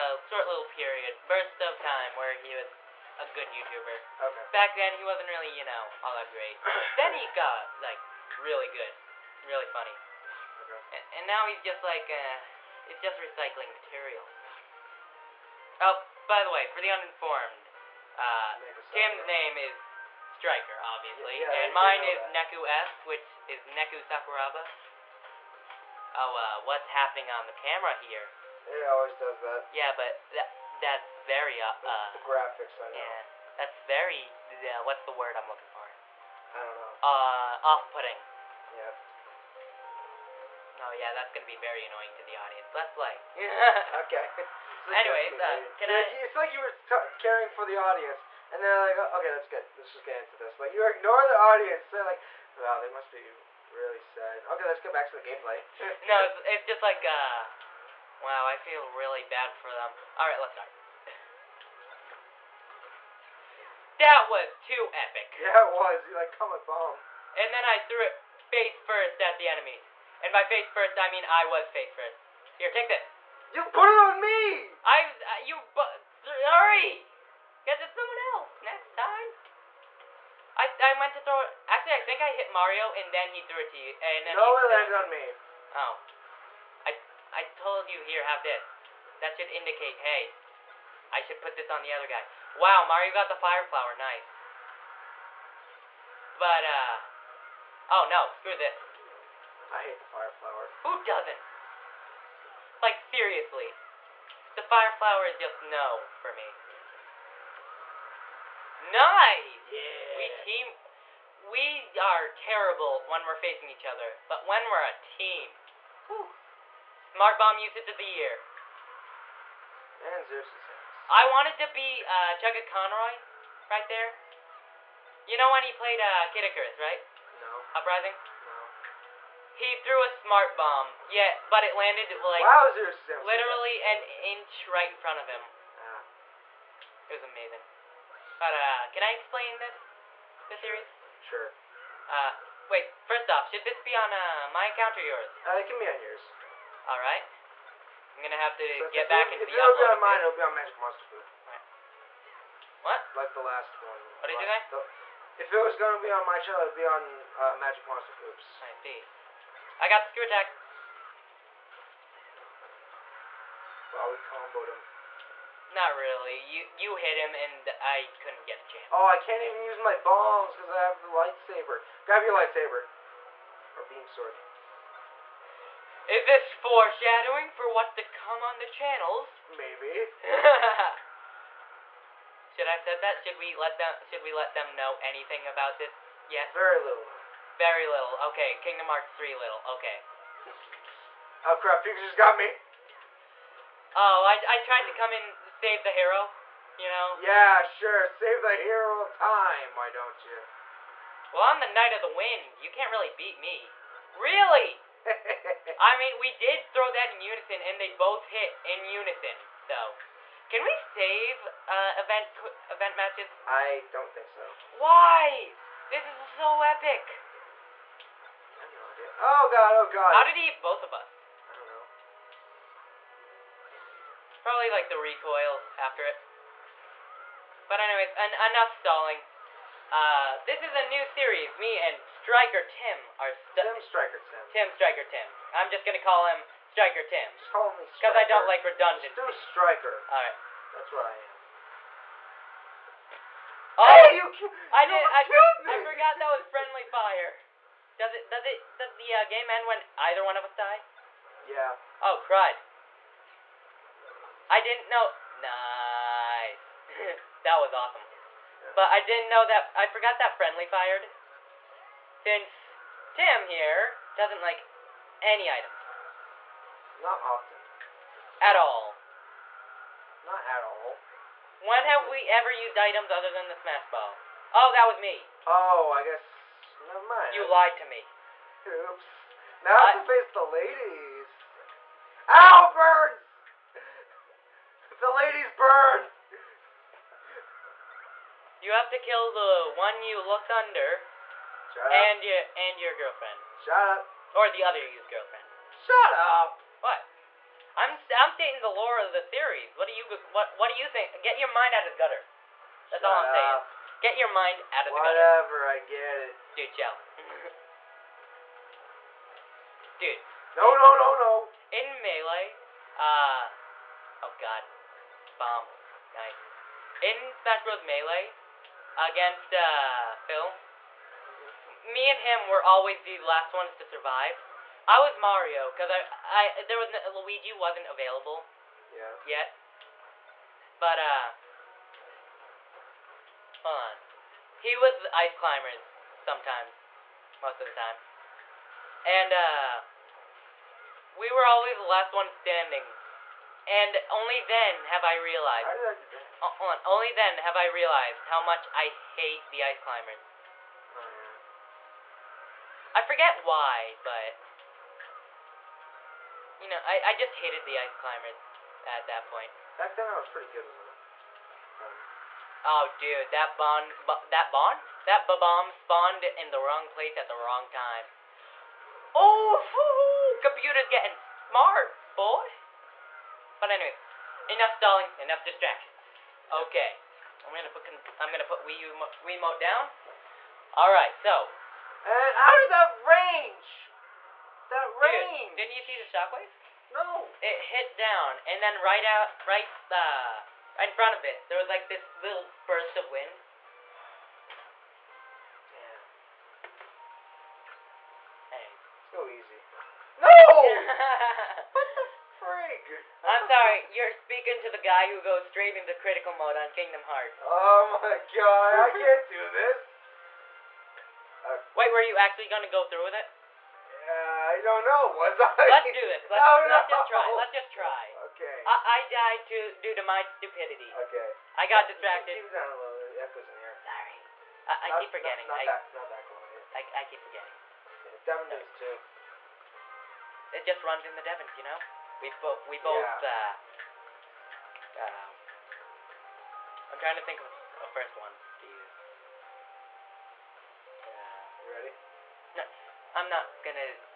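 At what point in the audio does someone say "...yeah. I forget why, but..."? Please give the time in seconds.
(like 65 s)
351 s.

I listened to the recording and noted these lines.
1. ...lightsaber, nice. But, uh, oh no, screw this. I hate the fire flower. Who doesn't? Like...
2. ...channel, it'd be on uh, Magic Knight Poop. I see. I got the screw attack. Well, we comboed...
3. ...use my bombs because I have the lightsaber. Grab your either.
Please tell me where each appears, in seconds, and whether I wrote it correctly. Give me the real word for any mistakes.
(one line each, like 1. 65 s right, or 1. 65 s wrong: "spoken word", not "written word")
1. 93 s wrong: "flower", not "lightsaber"
2. 156 s wrong: "Monster", not "Knight"
3. 169 s wrong: "lightsaber", not "either".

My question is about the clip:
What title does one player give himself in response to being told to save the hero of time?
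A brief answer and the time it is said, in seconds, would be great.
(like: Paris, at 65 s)
Knight of the Wind, at 201 s.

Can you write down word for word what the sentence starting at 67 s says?
And then I threw it face first at the enemy.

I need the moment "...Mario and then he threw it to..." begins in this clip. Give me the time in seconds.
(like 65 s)
82 s.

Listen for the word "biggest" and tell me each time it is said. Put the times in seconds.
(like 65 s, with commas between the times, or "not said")
not said.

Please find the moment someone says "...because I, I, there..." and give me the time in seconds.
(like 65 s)
325 s.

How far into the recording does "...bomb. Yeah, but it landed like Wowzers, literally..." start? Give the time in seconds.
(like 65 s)
130 s.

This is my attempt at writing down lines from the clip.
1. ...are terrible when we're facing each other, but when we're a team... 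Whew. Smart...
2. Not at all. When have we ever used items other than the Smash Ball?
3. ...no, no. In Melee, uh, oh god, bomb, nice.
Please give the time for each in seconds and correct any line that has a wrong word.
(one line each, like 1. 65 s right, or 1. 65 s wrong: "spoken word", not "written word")
1. 111 s right
2. 270 s right
3. 310 s right.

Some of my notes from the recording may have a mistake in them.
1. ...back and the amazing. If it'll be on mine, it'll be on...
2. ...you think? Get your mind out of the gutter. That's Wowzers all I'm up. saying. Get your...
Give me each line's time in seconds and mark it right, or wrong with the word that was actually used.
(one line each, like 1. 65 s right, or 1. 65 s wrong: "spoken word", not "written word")
1. 149 s wrong: "uploading", not "amazing"
2. 300 s wrong: "Shut", not "Wowzers".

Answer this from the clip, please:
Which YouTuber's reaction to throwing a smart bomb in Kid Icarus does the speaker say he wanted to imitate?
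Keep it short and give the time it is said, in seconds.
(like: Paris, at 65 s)
Chuggaaconroy, at 122 s.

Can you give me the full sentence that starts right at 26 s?
Oh, uh, what's happening on the camera here?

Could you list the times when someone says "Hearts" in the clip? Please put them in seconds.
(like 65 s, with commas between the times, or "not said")
188 s, 407 s.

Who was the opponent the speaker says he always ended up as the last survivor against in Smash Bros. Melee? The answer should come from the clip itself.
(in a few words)
Phil.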